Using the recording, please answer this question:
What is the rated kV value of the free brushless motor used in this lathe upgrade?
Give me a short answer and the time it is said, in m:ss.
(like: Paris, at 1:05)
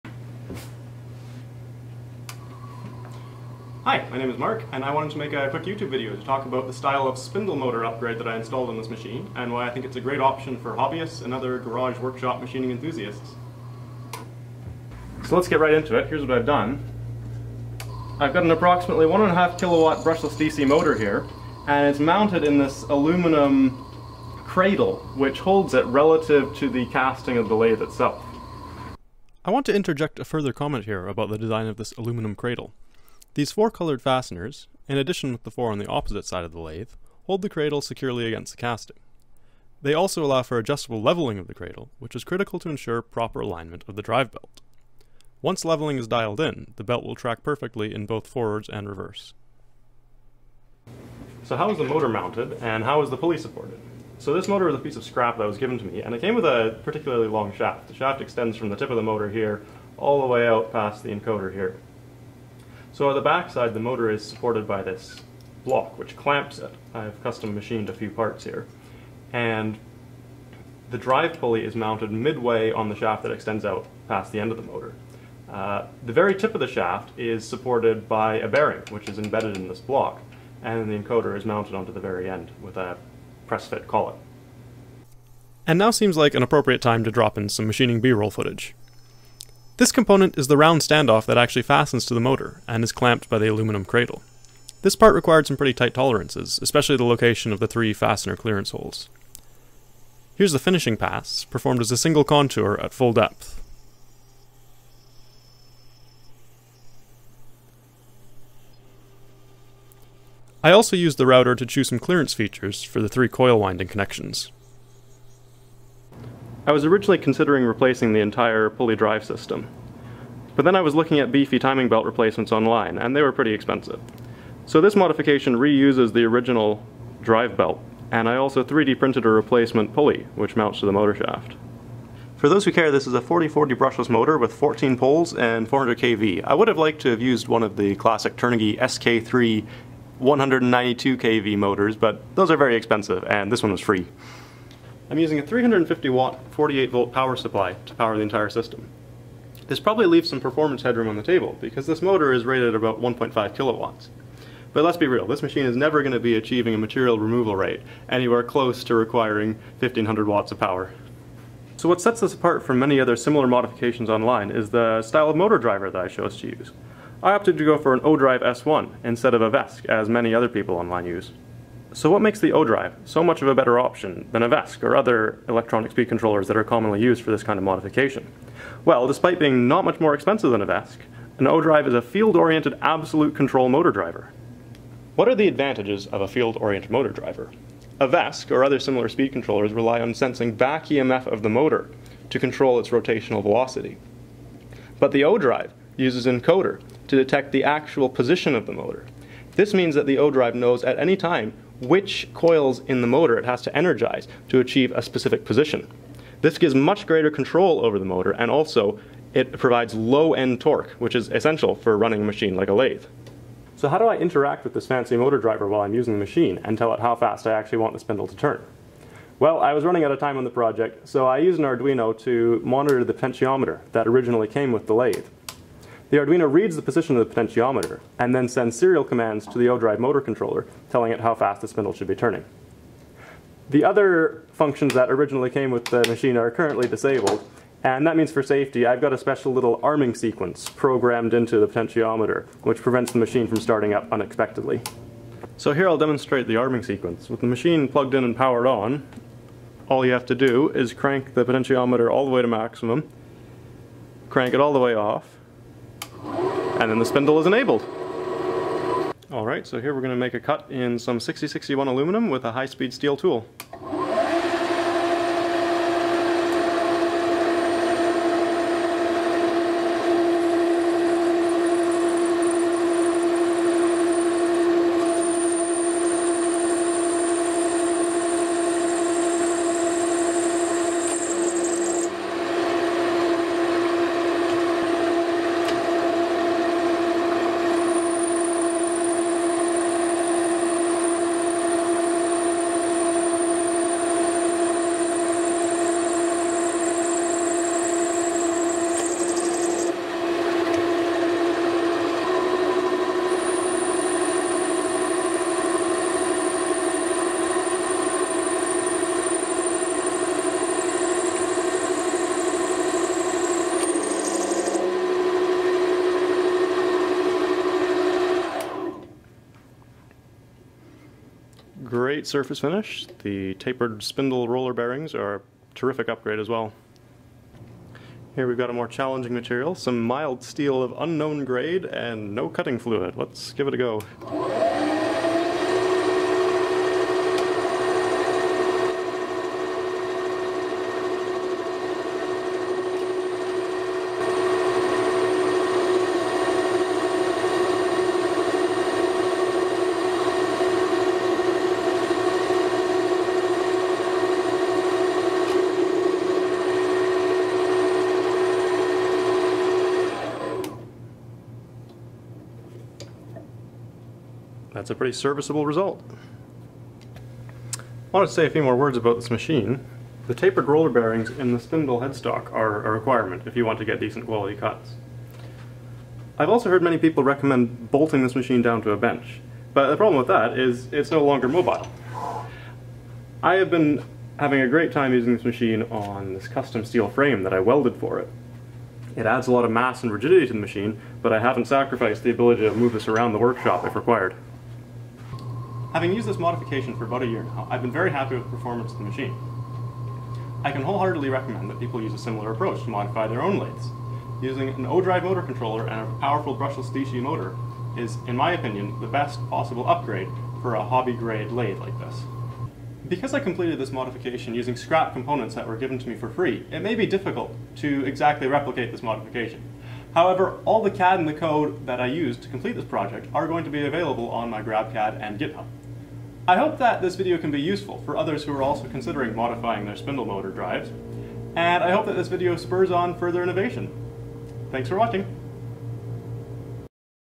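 400, at 2:15.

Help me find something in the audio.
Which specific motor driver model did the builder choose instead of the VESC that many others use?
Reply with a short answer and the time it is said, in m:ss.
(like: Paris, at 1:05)
ODrive S1, at 2:47.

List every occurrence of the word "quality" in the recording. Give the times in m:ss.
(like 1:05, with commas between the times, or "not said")
6:14.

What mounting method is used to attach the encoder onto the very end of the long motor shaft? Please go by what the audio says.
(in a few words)
press fit collet.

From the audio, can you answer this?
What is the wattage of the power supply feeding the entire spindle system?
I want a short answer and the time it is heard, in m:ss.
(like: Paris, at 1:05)
350 watts, at 2:25.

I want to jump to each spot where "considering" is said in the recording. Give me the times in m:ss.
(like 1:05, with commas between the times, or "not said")
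1:57, 7:08.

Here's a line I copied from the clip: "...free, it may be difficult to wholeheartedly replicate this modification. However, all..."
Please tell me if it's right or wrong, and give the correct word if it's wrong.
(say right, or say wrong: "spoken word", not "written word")
wrong: "exactly", not "wholeheartedly".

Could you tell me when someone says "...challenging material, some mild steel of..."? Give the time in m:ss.
5:28.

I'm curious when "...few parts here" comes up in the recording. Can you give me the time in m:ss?
1:07.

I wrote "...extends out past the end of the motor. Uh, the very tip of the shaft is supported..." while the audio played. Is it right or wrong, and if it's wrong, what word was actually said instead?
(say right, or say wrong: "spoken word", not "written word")
right.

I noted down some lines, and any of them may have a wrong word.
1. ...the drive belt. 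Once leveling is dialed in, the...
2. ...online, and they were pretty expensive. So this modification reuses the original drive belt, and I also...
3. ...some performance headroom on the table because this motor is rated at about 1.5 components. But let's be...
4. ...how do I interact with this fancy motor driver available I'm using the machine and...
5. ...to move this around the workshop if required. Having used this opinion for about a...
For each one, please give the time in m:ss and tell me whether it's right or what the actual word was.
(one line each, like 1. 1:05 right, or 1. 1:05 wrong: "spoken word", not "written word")
1. 0:43 right
2. 2:02 right
3. 2:30 wrong: "kilowatts", not "components"
4. 3:33 wrong: "while", not "available"
5. 6:32 wrong: "modification", not "opinion".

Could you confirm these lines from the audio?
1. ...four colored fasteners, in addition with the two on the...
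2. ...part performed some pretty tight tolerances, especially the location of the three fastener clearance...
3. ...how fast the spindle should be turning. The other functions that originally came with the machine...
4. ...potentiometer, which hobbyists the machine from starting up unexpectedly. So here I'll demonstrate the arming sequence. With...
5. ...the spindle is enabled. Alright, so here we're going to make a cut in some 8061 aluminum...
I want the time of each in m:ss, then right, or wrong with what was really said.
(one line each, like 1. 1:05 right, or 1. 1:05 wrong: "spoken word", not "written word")
1. 0:33 wrong: "four", not "two"
2. 1:34 wrong: "required", not "performed"
3. 3:51 right
4. 4:01 wrong: "prevents", not "hobbyists"
5. 4:16 wrong: "6061", not "8061".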